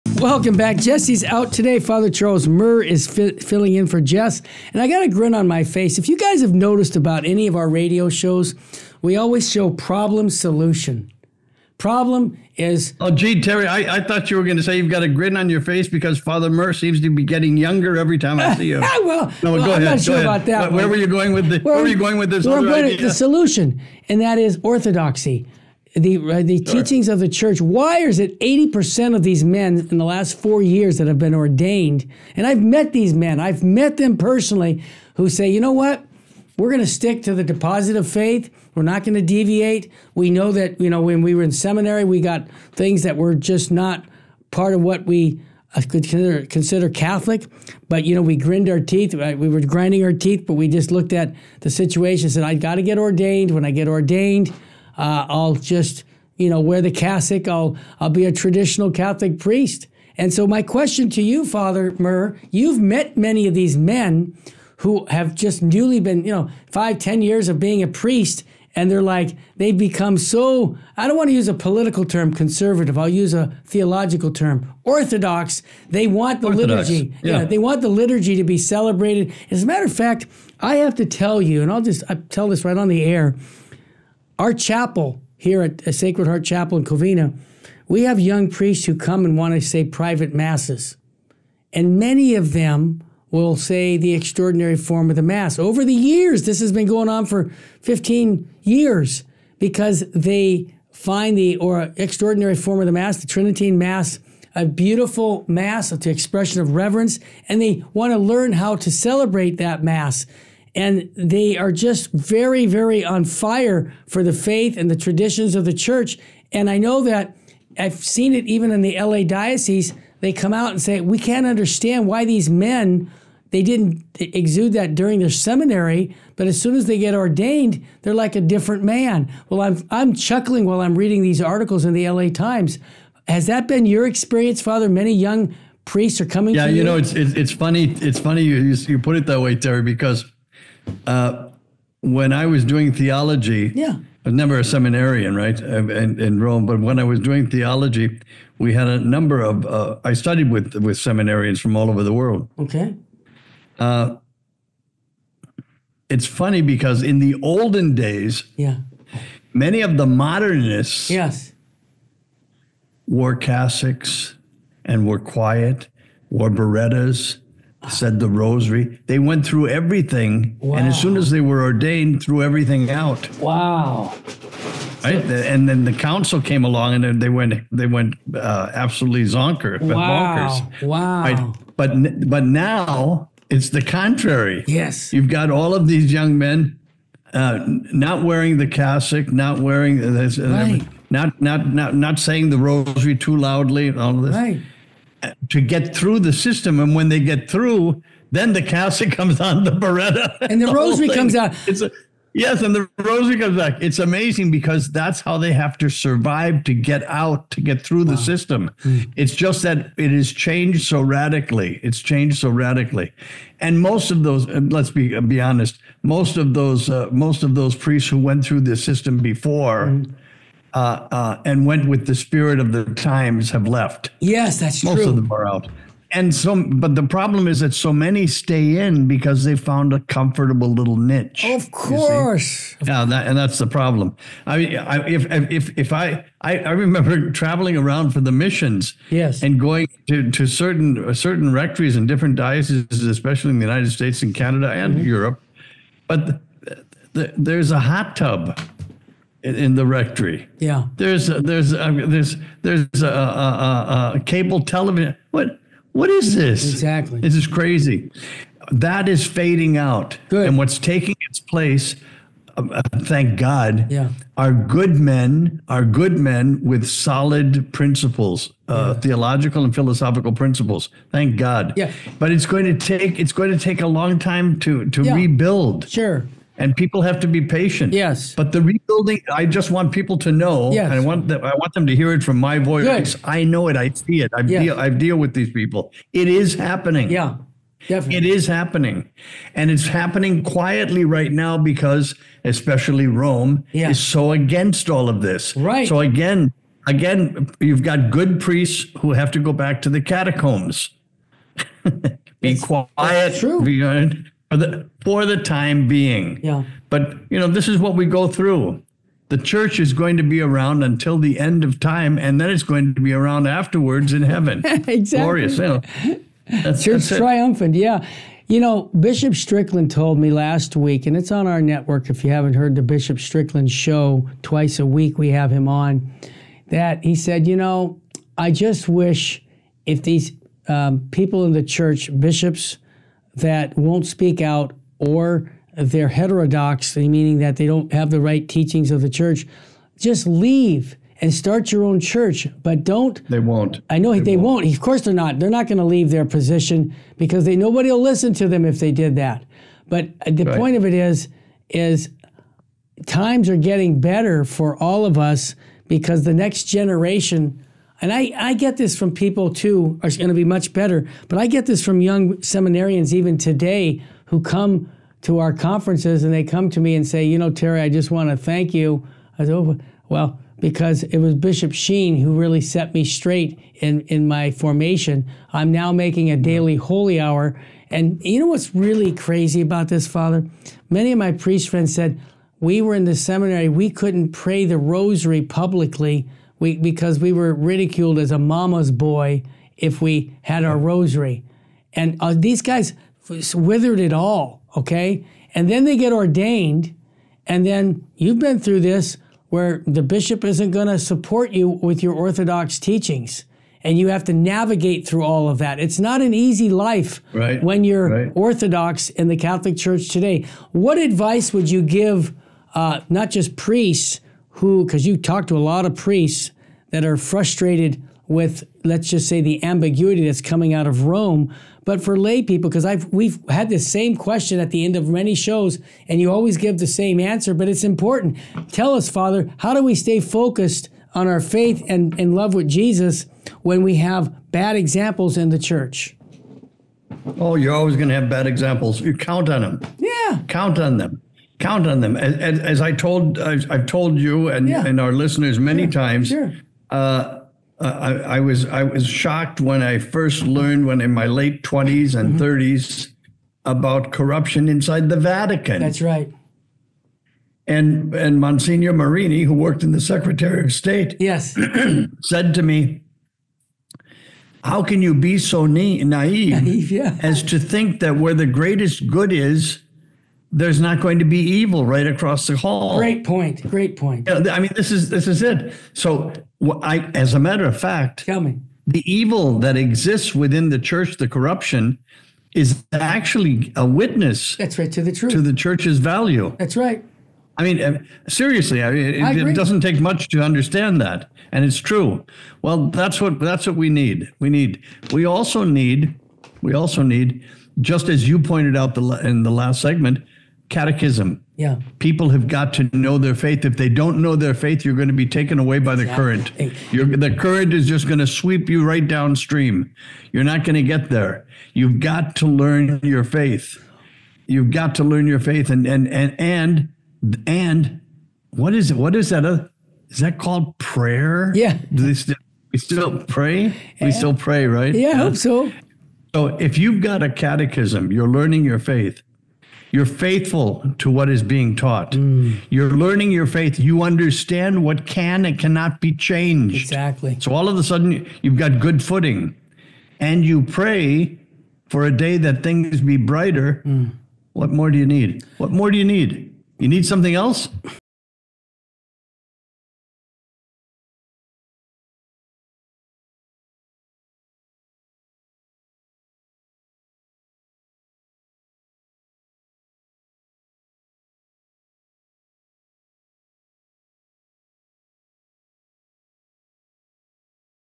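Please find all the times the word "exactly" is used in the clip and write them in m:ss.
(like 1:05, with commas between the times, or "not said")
4:16, 5:14, 8:56.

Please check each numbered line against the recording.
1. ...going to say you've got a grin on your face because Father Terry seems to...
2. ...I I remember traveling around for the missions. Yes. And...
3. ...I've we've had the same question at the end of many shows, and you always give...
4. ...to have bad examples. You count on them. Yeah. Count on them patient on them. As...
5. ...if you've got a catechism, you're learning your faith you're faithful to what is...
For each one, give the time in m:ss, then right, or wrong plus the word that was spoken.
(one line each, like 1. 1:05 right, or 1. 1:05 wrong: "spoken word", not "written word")
1. 0:14 wrong: "Murr", not "Terry"
2. 3:56 right
3. 7:02 right
4. 7:18 wrong: "count", not "patient"
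5. 8:46 right.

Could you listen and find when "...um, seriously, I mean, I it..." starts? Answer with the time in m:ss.
8:07.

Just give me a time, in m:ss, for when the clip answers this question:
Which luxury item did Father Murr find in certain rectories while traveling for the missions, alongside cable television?
4:07.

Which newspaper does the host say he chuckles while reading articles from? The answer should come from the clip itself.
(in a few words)
LA Times.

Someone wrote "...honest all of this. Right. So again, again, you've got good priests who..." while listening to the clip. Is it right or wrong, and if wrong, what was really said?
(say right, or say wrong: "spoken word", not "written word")
wrong: "against", not "honest".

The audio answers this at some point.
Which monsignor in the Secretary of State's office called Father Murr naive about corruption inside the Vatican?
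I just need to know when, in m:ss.
7:38.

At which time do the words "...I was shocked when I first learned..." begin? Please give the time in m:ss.
7:28.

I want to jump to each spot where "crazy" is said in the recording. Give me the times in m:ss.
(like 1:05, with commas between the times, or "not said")
4:17, 6:19.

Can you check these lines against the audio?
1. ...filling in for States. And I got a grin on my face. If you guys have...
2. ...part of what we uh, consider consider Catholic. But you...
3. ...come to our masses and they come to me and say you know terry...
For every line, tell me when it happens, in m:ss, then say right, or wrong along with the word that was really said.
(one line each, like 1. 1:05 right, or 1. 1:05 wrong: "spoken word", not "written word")
1. 0:03 wrong: "Jess", not "States"
2. 0:44 right
3. 6:04 wrong: "conferences", not "masses".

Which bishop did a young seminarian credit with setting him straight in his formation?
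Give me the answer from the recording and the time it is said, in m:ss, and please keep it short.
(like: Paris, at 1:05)
Bishop Sheen, at 6:11.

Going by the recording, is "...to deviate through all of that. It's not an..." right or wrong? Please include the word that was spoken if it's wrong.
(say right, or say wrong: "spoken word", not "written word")
wrong: "navigate", not "deviate".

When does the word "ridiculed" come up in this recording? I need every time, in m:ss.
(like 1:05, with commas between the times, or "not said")
6:27.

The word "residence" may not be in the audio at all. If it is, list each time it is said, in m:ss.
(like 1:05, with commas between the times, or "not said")
not said.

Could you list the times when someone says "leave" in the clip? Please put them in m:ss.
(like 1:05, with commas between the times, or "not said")
5:40, 5:45.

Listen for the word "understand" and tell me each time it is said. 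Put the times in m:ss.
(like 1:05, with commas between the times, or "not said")
2:01, 8:10, 8:54.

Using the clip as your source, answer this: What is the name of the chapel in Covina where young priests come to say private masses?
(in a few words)
Sacred Heart Chapel.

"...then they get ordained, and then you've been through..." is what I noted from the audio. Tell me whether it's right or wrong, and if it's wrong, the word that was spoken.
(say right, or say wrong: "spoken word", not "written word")
right.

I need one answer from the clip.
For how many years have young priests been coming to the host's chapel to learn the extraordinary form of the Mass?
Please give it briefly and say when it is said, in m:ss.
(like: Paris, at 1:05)
15, at 1:37.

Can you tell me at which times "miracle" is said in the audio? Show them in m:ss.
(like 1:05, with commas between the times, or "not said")
not said.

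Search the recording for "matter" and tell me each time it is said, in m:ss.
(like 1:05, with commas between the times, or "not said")
1:19, 7:57.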